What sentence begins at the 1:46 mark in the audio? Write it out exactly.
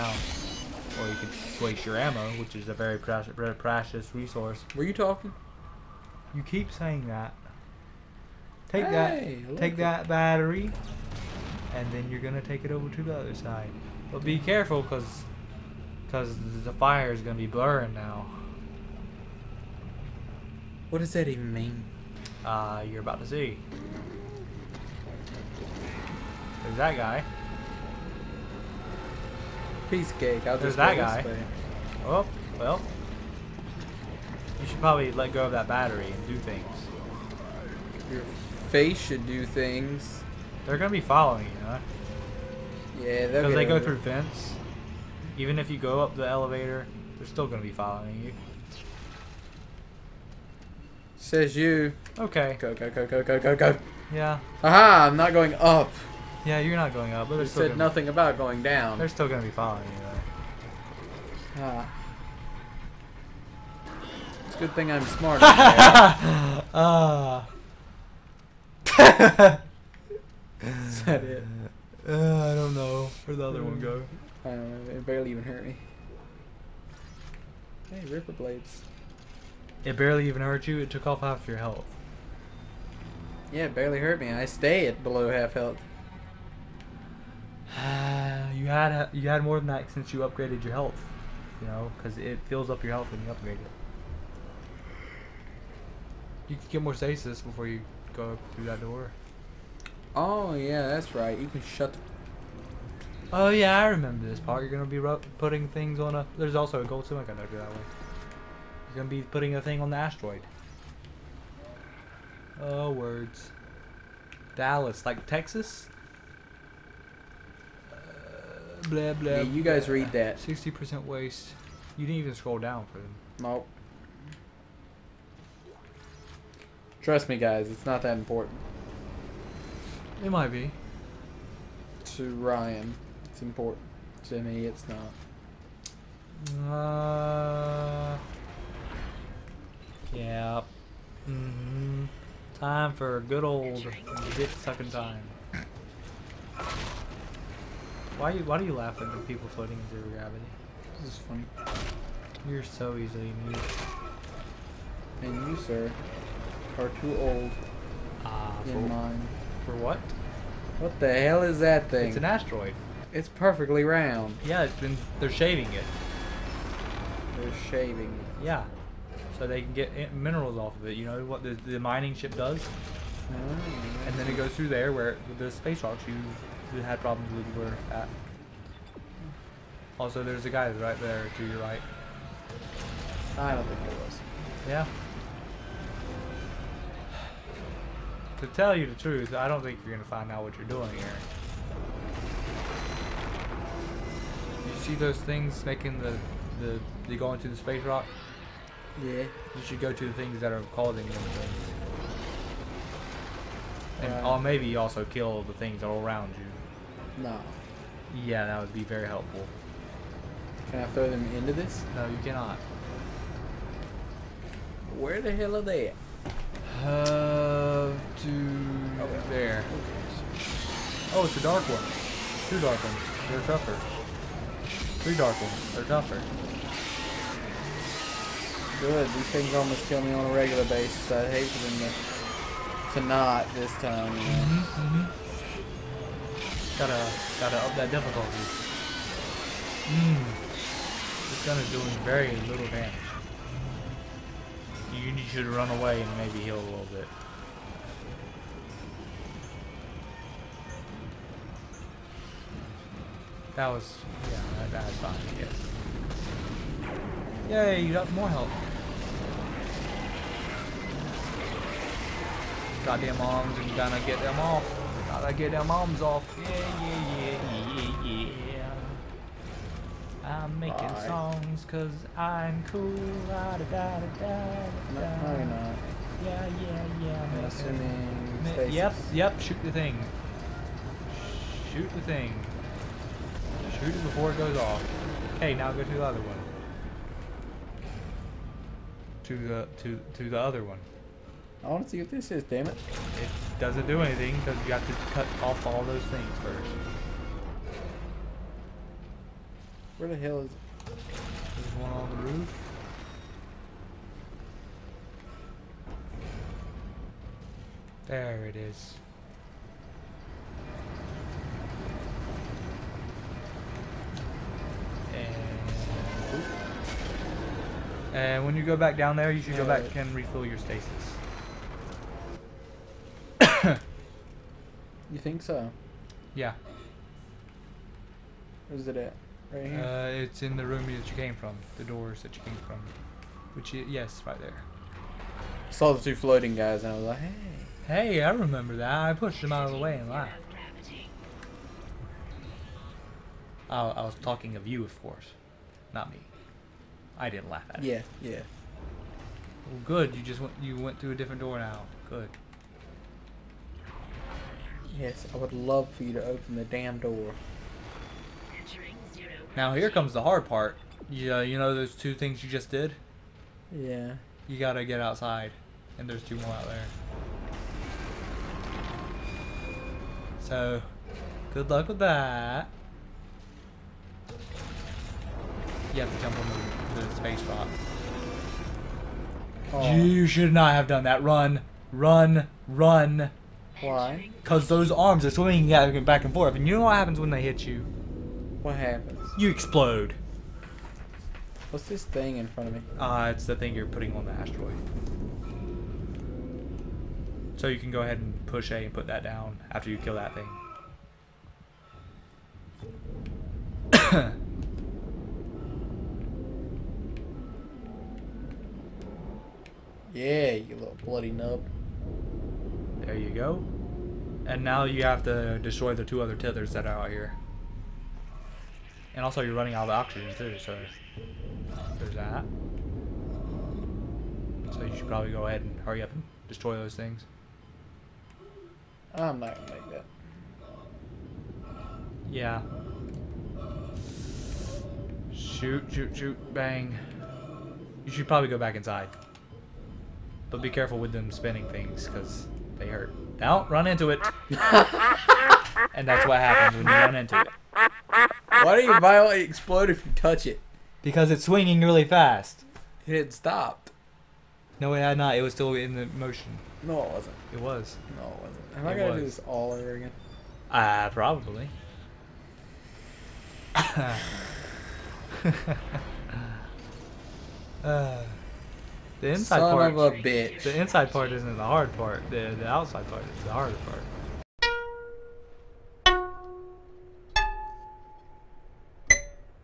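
There's also a gold stomach I do that one.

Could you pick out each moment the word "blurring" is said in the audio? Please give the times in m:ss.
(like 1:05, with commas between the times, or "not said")
0:17.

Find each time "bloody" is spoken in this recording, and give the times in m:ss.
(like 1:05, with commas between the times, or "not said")
6:51.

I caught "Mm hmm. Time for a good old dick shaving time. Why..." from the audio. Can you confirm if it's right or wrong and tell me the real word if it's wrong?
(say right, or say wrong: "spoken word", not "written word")
wrong: "sucking", not "shaving".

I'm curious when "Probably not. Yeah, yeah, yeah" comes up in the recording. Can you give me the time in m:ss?
4:35.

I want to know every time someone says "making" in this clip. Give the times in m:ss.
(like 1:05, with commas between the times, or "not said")
3:15, 4:30.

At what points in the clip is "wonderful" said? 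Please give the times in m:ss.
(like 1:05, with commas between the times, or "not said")
not said.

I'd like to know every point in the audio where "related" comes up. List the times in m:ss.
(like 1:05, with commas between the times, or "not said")
not said.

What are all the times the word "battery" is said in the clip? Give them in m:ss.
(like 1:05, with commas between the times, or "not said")
0:10, 0:35.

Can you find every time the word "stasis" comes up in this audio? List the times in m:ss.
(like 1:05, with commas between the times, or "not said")
1:36, 5:20.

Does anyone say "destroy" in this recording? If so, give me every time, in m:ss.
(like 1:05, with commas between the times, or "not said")
6:55, 7:06.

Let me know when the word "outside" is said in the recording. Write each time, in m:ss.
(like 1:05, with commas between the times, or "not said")
6:04, 7:52.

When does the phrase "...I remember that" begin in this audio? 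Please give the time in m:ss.
5:38.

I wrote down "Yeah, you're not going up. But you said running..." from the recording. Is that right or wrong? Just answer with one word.
wrong.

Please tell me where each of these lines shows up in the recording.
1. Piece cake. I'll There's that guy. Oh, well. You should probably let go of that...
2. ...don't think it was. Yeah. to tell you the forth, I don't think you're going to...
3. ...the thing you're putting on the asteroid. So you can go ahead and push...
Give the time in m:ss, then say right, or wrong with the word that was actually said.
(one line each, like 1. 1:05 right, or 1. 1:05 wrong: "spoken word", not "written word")
1. 0:29 right
2. 3:03 wrong: "truth", not "forth"
3. 6:33 right.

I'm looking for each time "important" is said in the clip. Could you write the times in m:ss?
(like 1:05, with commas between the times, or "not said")
2:08, 2:13.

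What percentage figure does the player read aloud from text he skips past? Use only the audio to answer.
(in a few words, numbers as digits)
60%.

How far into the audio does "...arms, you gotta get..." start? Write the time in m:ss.
4:23.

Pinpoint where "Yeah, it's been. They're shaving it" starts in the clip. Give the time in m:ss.
2:44.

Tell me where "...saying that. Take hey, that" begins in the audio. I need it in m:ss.
0:06.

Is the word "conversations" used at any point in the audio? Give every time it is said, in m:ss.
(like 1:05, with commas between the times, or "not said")
not said.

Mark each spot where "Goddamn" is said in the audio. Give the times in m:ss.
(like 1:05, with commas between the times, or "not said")
4:22.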